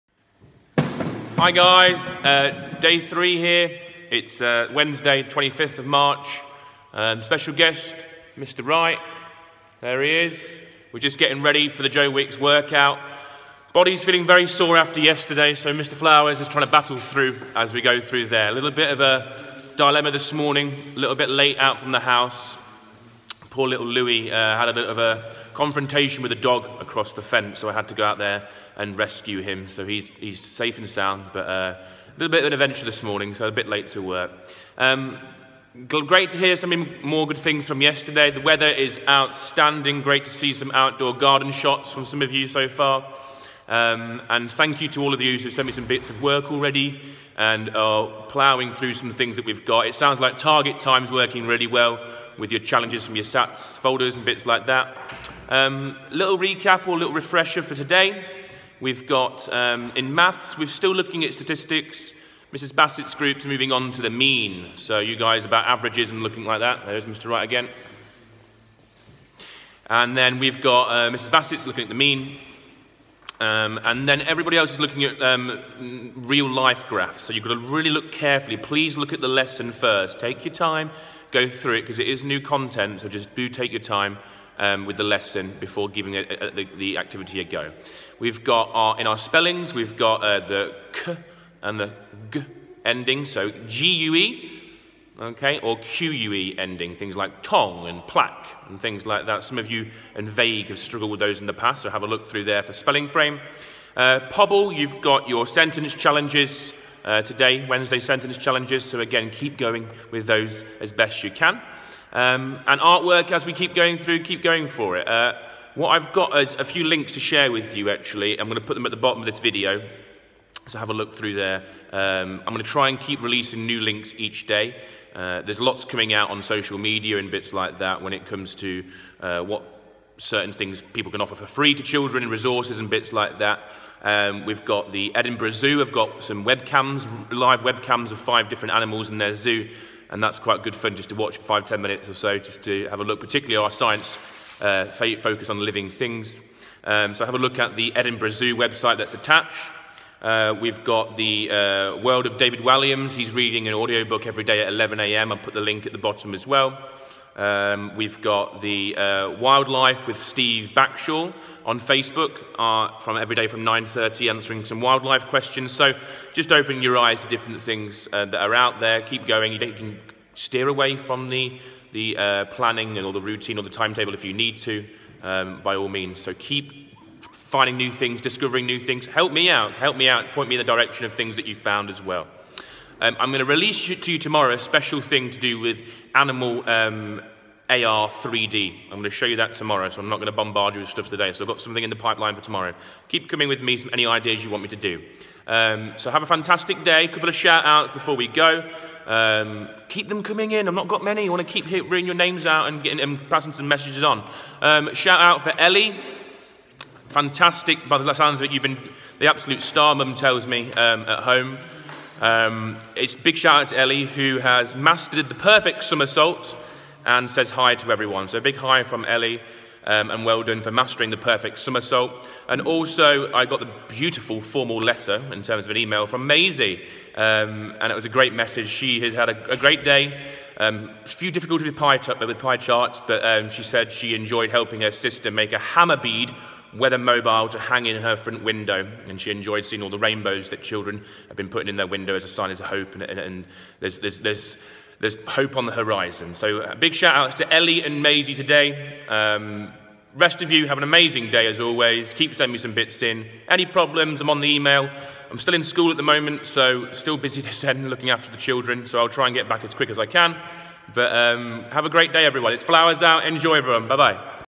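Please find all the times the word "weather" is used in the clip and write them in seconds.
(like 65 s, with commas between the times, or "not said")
38 s, 236 s.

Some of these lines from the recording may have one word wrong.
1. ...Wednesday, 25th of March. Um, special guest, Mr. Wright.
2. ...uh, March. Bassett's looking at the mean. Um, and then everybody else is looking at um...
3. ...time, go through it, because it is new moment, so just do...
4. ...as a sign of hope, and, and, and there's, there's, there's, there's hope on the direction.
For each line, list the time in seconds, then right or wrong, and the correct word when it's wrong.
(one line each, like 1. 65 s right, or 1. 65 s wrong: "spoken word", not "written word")
1. 4 s right
2. 70 s wrong: "Mrs", not "March"
3. 80 s wrong: "content", not "moment"
4. 242 s wrong: "horizon", not "direction".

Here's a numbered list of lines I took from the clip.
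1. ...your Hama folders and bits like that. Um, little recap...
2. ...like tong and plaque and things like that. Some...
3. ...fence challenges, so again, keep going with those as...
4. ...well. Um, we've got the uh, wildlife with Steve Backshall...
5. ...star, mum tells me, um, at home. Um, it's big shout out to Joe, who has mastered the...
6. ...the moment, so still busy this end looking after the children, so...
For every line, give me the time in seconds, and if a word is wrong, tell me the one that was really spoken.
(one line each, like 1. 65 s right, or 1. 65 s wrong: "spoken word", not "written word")
1. 53 s wrong: "SATs", not "Hama"
2. 97 s right
3. 107 s wrong: "sentence", not "fence"
4. 156 s right
5. 209 s wrong: "Ellie", not "Joe"
6. 255 s right.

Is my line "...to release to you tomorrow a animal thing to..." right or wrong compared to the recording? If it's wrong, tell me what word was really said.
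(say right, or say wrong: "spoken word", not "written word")
wrong: "special", not "animal".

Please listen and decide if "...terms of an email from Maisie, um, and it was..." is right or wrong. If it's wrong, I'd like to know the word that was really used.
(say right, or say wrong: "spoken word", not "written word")
right.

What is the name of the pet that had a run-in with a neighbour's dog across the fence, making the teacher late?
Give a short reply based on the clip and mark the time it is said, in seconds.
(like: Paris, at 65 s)
Louie, at 23 s.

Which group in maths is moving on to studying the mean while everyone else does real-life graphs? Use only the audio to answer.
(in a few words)
Mrs. Bassett's group.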